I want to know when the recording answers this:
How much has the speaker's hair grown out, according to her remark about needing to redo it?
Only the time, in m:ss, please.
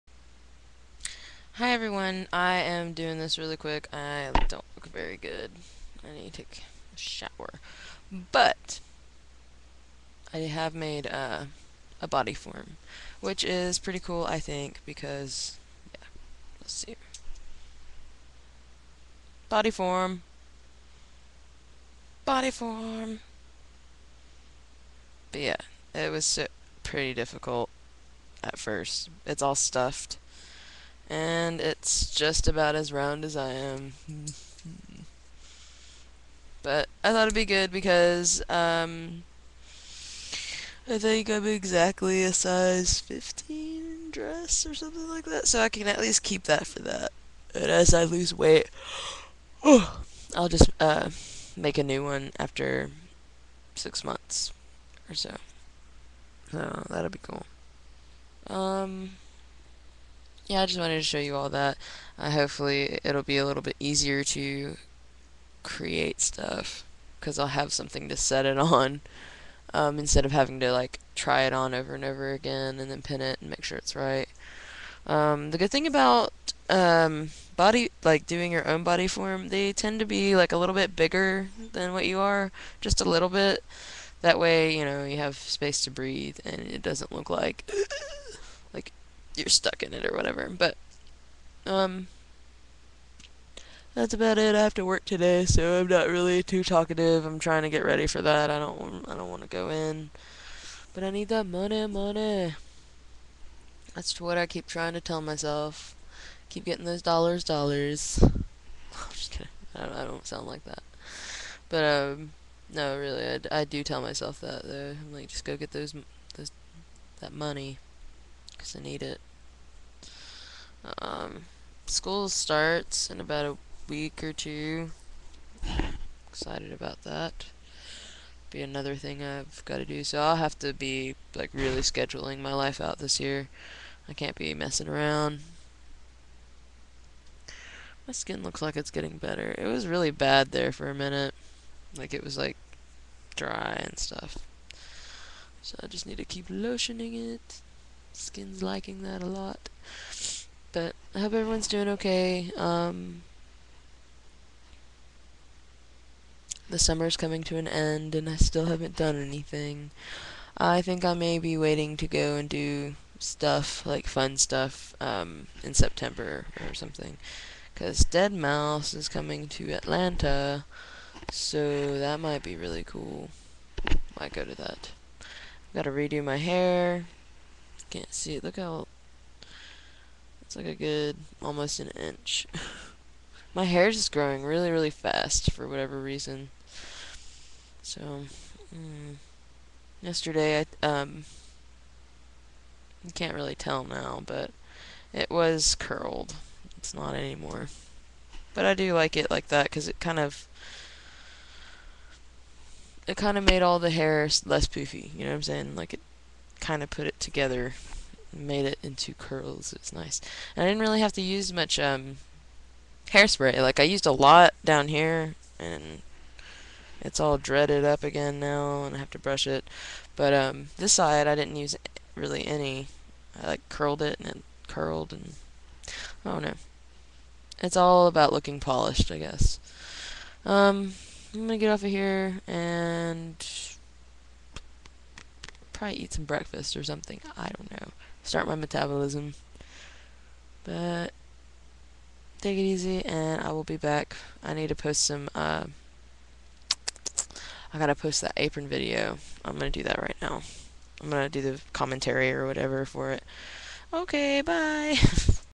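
3:01.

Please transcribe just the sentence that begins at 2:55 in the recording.
Gotta redo my hair, can't see it.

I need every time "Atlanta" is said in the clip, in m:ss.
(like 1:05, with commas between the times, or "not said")
2:49.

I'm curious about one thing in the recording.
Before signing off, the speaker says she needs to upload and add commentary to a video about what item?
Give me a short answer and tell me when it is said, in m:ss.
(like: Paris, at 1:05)
apron, at 4:08.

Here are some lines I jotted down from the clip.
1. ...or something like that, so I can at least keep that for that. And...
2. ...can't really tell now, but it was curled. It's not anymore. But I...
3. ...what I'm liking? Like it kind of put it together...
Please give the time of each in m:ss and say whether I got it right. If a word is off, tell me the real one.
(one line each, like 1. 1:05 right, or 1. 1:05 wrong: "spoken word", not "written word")
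1. 0:44 right
2. 3:13 right
3. 3:25 wrong: "saying", not "liking".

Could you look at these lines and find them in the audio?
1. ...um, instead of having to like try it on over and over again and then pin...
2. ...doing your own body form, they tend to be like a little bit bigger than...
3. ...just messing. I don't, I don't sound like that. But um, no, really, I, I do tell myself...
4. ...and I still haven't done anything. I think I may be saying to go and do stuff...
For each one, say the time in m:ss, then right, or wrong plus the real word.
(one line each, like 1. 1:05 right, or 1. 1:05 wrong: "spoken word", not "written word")
1. 1:09 right
2. 1:18 right
3. 1:49 wrong: "kidding", not "messing"
4. 2:38 wrong: "waiting", not "saying".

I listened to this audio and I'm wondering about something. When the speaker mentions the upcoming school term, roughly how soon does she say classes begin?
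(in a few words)
about a week.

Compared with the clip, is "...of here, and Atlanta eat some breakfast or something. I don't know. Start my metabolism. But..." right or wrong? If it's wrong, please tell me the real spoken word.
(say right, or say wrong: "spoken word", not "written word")
wrong: "Try", not "Atlanta".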